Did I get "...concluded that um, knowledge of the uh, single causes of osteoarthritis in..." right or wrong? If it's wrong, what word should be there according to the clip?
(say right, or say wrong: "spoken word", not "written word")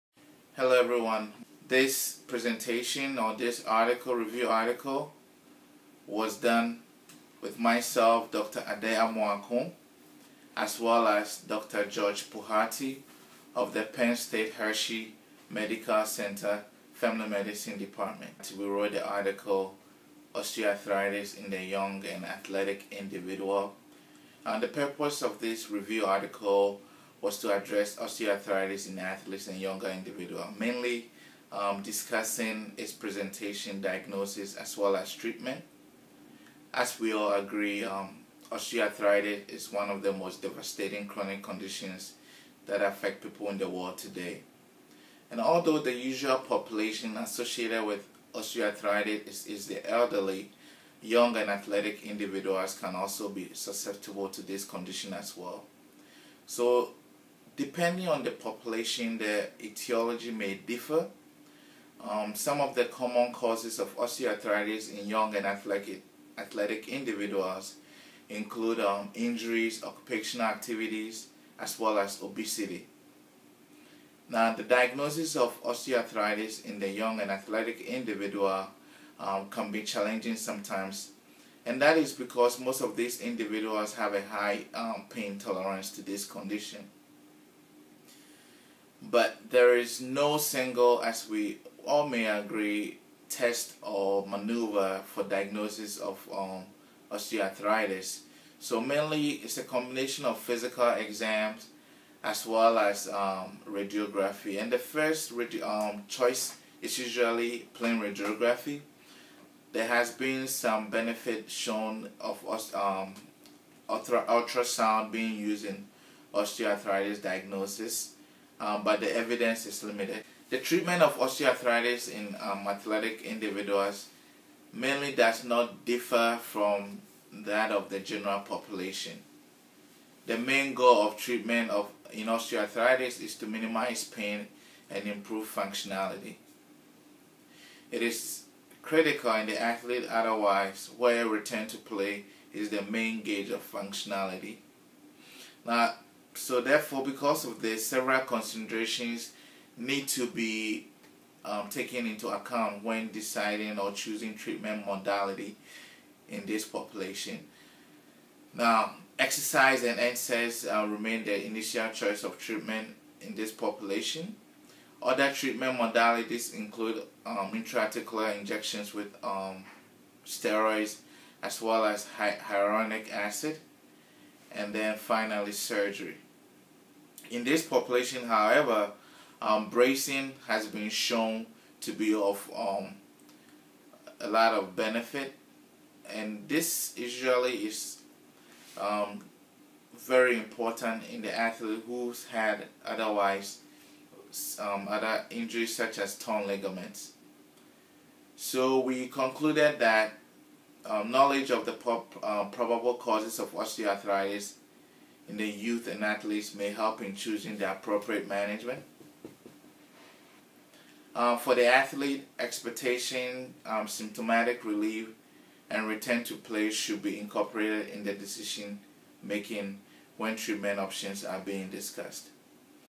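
wrong: "probable", not "single".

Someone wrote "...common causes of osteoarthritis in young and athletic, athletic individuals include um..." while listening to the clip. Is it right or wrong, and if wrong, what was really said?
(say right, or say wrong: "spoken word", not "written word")
right.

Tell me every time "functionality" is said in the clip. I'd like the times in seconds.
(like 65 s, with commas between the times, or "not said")
135 s, 143 s.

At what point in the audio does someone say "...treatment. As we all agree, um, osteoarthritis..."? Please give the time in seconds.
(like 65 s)
35 s.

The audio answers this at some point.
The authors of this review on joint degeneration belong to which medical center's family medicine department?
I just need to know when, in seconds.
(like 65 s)
13 s.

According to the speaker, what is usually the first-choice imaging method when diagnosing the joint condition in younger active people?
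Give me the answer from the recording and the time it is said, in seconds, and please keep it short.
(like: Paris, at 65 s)
Plain radiography, at 107 s.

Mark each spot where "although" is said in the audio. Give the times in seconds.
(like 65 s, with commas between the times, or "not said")
45 s.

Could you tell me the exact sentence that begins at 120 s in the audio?
The treatment of osteoarthritis in um, athletic individuals mainly does not differ from that of the general population.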